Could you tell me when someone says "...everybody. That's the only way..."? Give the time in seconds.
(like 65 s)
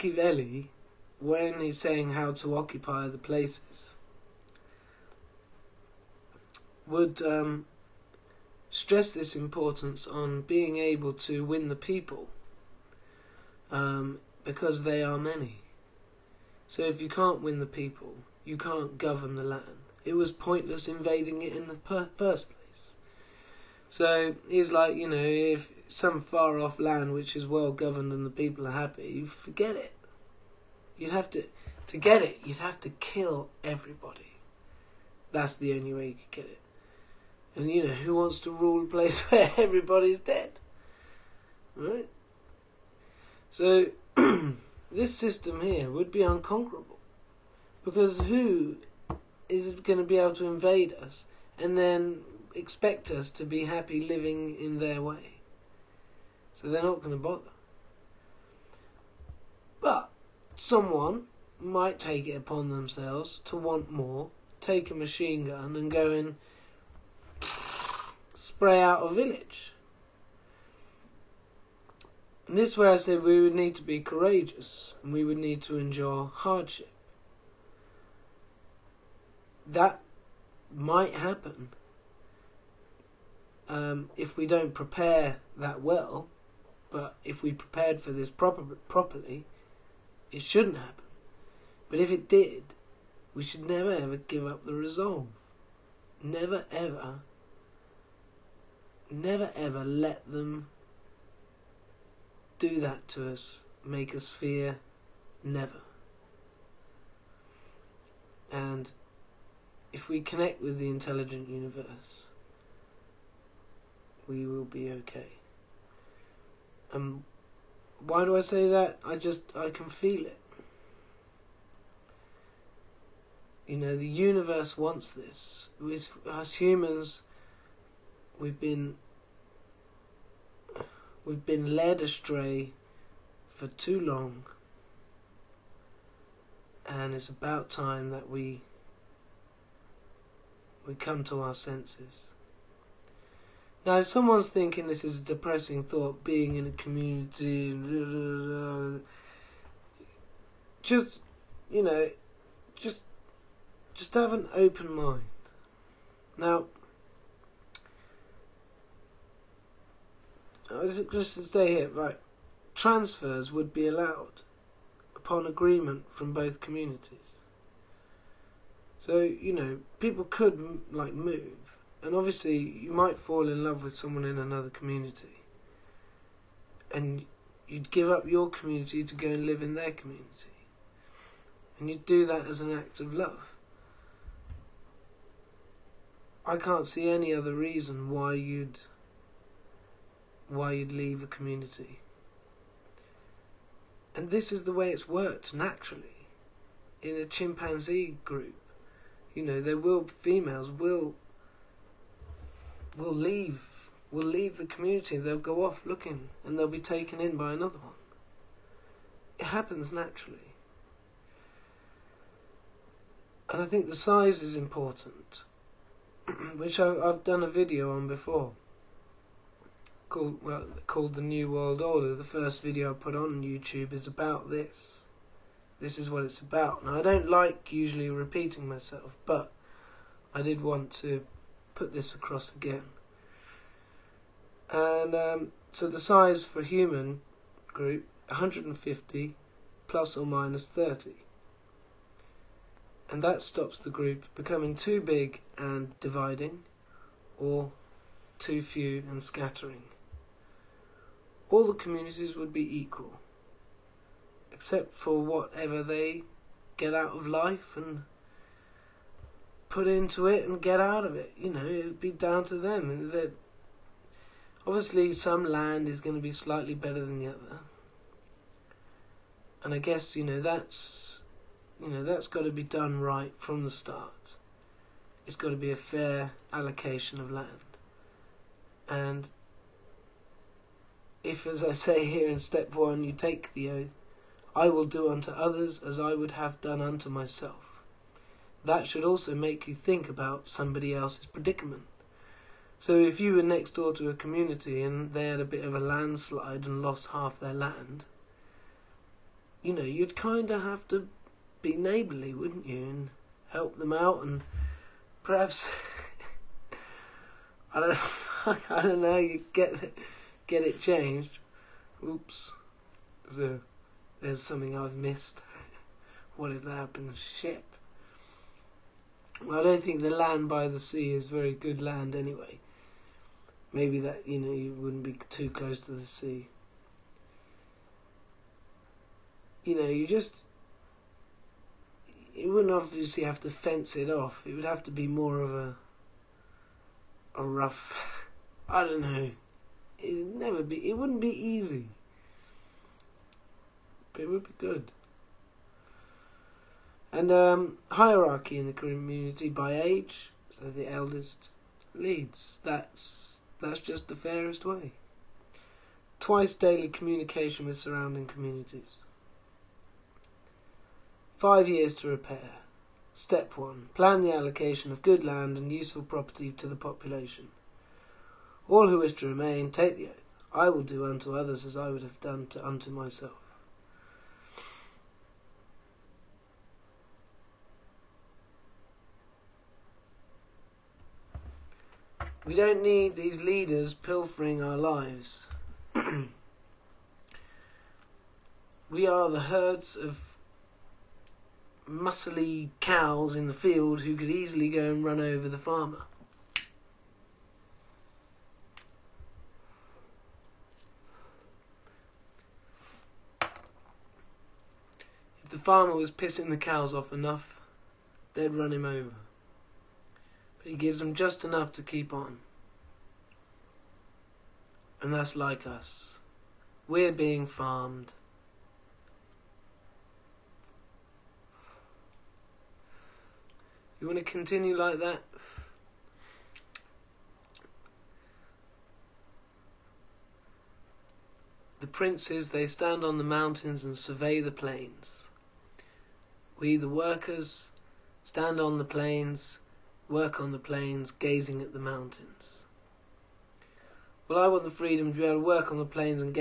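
33 s.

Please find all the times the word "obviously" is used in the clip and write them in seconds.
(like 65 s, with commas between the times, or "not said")
172 s, 264 s, 332 s.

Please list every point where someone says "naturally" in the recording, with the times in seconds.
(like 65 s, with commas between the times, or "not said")
195 s, 209 s.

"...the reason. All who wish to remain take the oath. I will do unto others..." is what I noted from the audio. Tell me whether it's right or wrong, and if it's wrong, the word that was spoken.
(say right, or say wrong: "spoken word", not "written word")
wrong: "population", not "reason".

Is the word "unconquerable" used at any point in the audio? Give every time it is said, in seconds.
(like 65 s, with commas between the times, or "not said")
46 s.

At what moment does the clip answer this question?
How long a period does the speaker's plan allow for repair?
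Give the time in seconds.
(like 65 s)
361 s.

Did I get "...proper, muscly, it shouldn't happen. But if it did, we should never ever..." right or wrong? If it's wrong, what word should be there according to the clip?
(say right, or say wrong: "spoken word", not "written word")
wrong: "properly", not "muscly".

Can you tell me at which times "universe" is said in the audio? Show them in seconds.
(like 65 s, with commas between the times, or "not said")
111 s, 124 s.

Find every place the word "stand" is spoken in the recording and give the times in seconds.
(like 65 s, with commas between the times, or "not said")
432 s, 438 s.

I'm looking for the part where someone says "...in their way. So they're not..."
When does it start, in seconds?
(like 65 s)
54 s.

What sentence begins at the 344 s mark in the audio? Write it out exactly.
But it would be good and um, hierarchy in the community by age.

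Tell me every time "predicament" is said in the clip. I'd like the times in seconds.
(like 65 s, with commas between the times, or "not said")
291 s.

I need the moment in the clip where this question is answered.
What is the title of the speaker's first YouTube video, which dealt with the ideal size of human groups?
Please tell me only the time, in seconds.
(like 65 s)
221 s.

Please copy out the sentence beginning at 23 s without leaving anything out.
So he's like, you know, if some far off land which is well governed and the people are happy, you forget it.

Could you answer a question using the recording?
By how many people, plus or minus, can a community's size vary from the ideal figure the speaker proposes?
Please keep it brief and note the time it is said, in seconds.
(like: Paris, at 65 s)
30, at 240 s.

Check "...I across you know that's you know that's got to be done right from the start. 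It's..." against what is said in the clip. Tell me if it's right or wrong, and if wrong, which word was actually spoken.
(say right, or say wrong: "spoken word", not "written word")
wrong: "guess", not "across".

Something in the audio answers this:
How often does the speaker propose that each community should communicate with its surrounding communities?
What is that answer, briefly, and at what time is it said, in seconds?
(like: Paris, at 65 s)
Twice daily, at 356 s.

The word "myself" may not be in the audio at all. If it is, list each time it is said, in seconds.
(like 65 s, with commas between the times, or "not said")
228 s, 287 s, 372 s.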